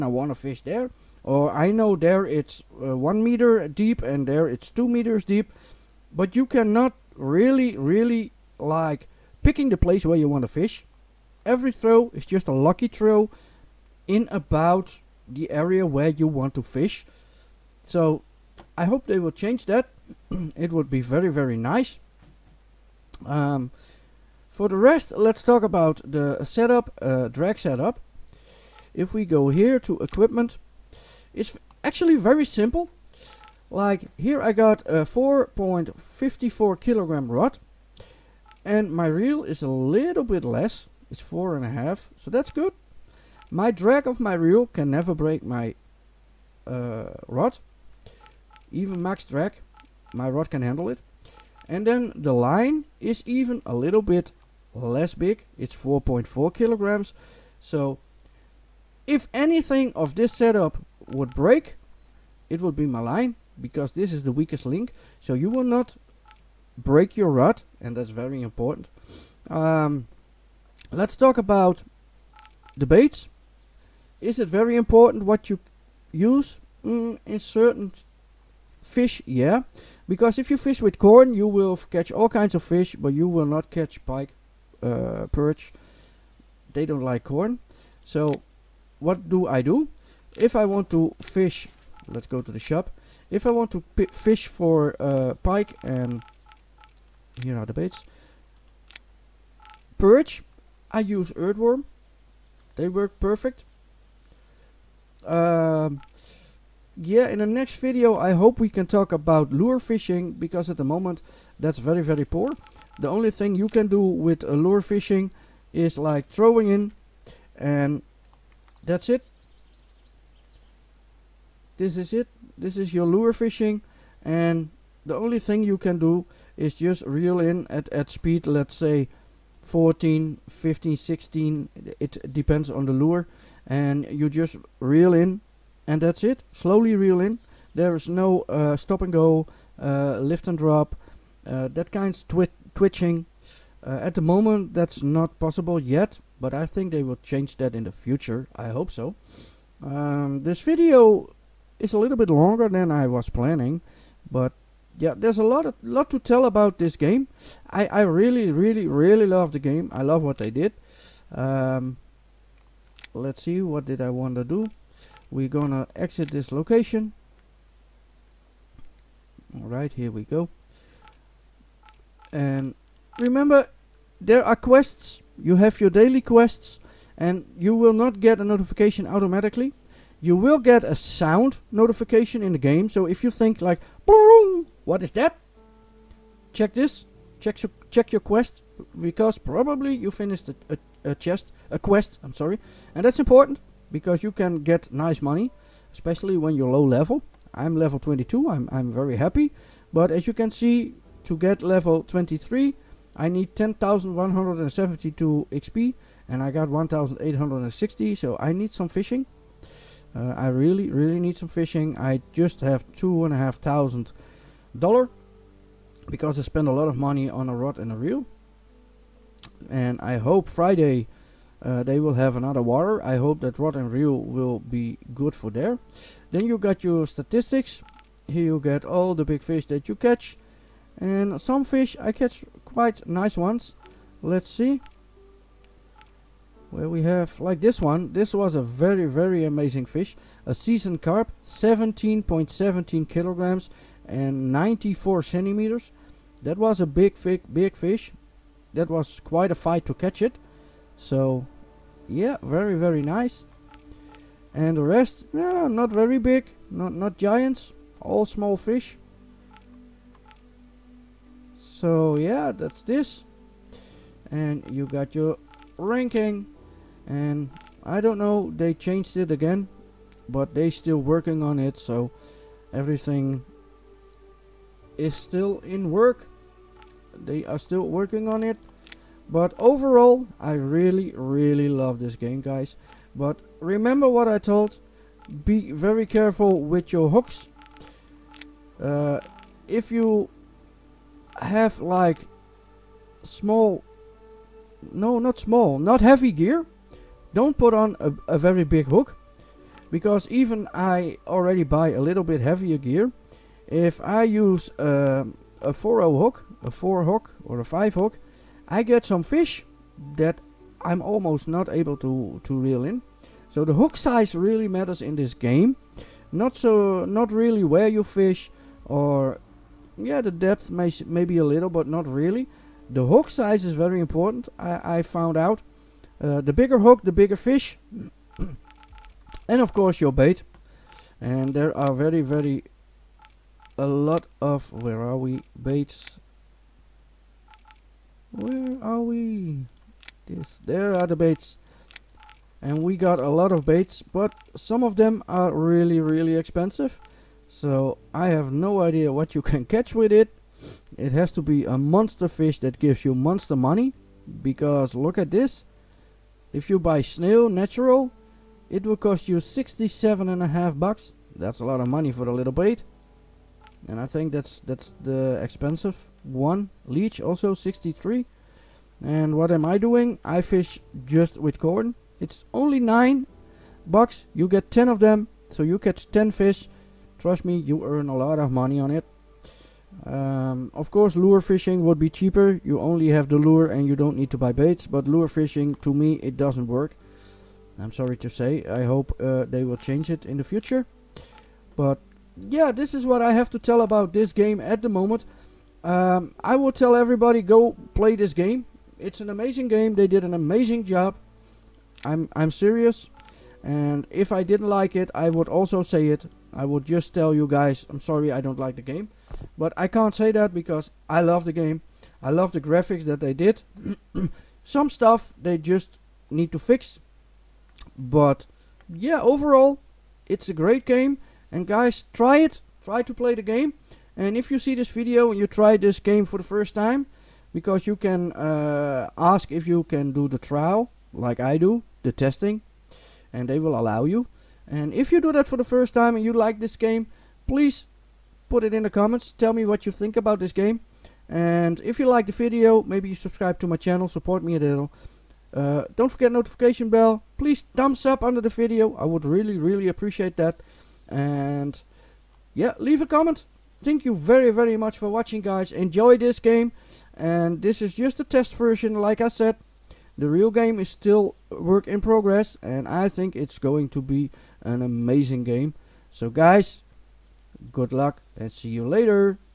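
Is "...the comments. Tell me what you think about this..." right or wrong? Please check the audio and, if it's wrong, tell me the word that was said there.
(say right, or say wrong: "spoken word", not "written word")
right.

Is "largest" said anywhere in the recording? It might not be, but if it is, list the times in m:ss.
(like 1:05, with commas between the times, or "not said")
not said.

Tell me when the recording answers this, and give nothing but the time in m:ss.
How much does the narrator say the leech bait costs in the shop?
6:07.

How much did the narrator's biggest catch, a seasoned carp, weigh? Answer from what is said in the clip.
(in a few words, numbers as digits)
17.17 kilograms.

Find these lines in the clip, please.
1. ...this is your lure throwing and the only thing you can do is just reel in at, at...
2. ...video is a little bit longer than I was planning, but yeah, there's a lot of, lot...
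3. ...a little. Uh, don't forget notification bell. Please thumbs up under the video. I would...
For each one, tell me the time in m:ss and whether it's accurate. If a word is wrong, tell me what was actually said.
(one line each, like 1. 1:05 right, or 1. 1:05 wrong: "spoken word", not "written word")
1. 2:02 wrong: "fishing", not "throwing"
2. 2:30 right
3. 7:24 right.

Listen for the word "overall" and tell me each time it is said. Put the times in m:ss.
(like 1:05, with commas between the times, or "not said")
4:39, 6:59.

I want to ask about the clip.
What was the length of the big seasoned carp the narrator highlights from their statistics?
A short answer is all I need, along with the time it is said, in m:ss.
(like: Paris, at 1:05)
94 centimeters, at 4:04.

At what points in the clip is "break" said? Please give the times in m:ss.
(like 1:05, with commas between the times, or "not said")
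0:45, 1:01, 1:06.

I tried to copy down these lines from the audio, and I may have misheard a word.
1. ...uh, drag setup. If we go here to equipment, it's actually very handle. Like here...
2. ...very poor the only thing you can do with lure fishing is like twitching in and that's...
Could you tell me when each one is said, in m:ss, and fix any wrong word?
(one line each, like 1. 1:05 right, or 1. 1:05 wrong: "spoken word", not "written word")
1. 0:27 wrong: "simple", not "handle"
2. 1:52 wrong: "throwing", not "twitching".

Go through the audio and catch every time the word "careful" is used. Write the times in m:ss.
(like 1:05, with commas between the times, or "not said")
4:46.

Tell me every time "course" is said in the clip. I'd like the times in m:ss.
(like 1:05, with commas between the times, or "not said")
5:29, 6:20.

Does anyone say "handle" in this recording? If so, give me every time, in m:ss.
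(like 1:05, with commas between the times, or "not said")
0:50.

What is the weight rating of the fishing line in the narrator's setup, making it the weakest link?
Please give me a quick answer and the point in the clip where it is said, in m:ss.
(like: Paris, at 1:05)
4.4 kilograms, at 0:55.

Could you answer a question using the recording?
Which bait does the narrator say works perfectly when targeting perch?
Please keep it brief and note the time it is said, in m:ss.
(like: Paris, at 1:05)
earthworm, at 1:41.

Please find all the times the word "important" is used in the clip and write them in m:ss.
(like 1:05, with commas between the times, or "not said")
1:08, 1:14, 3:13, 5:24.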